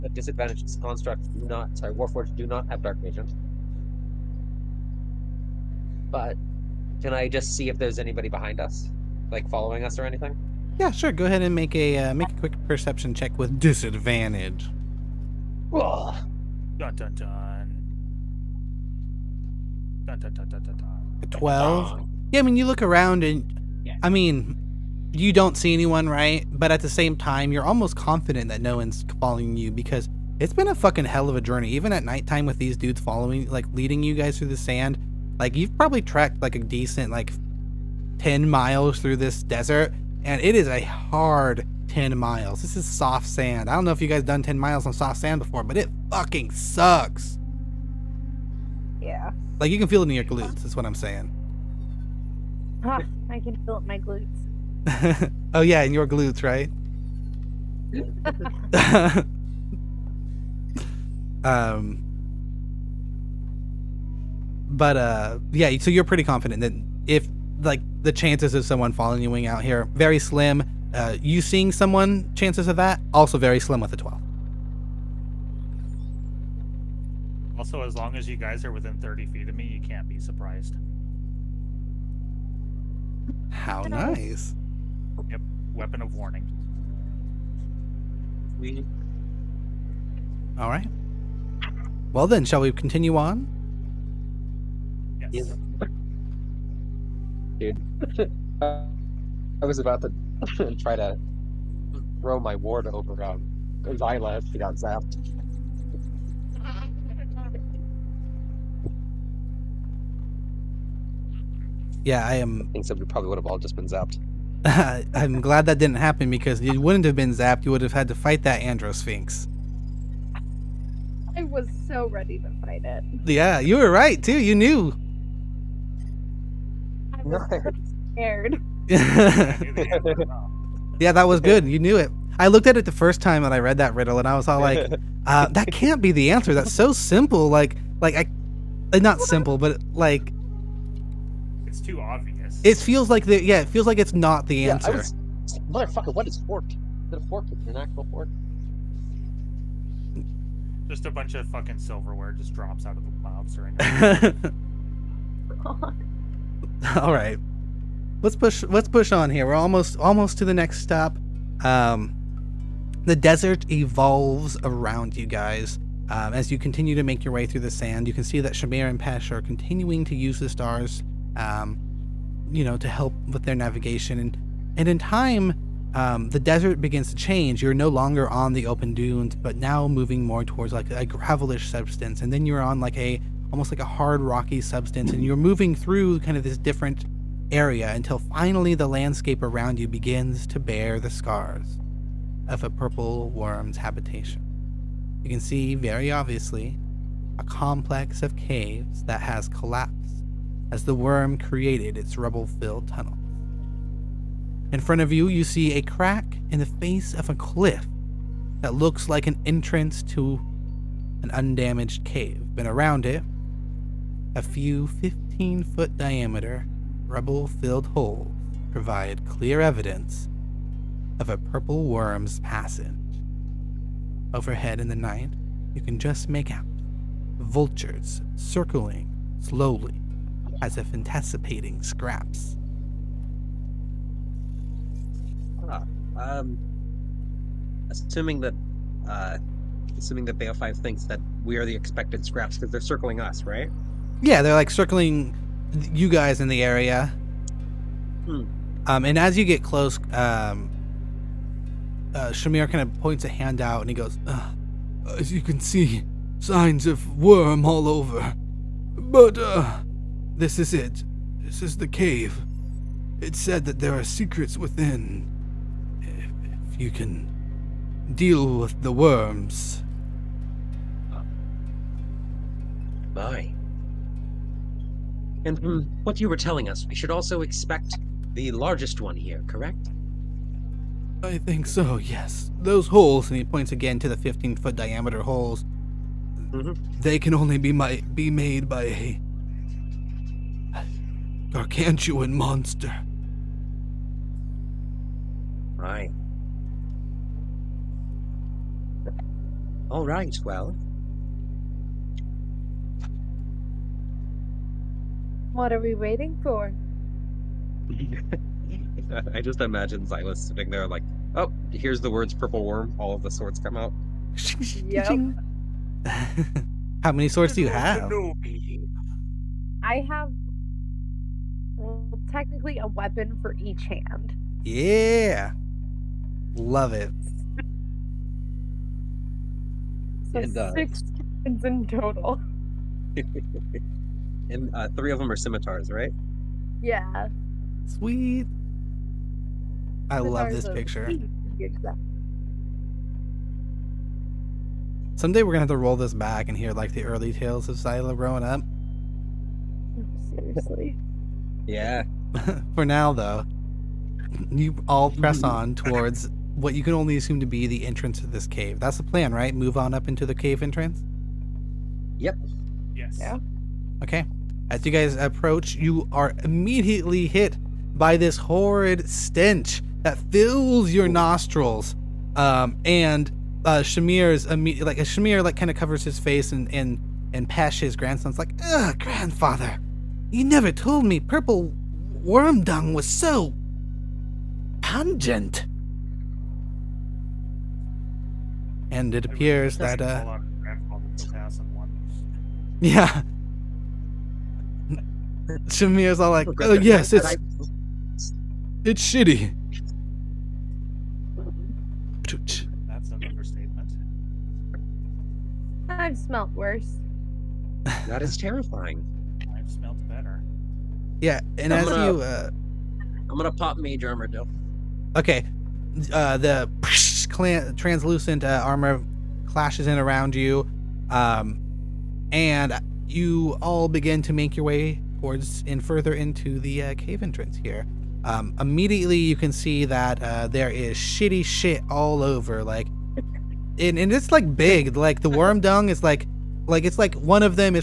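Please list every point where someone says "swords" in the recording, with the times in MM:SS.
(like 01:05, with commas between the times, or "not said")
05:13, 05:17.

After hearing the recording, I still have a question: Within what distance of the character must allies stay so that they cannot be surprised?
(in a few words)
30 feet.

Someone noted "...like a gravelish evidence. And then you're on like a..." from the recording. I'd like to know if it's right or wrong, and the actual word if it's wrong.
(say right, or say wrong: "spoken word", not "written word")
wrong: "substance", not "evidence".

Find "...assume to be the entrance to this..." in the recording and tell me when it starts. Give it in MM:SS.
05:57.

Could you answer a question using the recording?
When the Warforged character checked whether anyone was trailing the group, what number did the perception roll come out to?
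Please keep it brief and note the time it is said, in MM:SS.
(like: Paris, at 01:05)
12, at 00:21.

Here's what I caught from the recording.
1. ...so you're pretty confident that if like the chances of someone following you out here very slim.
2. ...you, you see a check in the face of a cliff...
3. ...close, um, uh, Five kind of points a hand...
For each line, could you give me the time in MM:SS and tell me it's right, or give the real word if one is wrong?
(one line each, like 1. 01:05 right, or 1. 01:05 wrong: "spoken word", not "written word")
1. 01:05 right
2. 03:25 wrong: "crack", not "check"
3. 04:09 wrong: "Shamir", not "Five".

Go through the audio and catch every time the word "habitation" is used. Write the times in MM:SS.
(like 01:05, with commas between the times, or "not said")
03:13.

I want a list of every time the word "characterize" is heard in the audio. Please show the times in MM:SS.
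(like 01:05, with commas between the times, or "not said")
not said.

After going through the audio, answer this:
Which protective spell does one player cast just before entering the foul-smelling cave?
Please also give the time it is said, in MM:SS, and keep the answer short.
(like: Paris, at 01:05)
Mage armor, at 06:53.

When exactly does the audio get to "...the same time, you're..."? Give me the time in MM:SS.
00:26.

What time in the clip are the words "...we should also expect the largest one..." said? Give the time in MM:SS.
04:36.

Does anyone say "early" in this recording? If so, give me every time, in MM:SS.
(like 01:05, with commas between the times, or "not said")
05:47.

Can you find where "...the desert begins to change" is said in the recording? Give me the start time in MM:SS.
02:56.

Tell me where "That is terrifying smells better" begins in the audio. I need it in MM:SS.
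06:48.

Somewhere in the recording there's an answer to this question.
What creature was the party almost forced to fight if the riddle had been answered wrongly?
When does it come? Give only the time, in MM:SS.
01:58.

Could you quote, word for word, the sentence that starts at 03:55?
Ah, um, assuming that, uh, assuming that Bale Five thinks that we are the expected scraps because they're circling us, right?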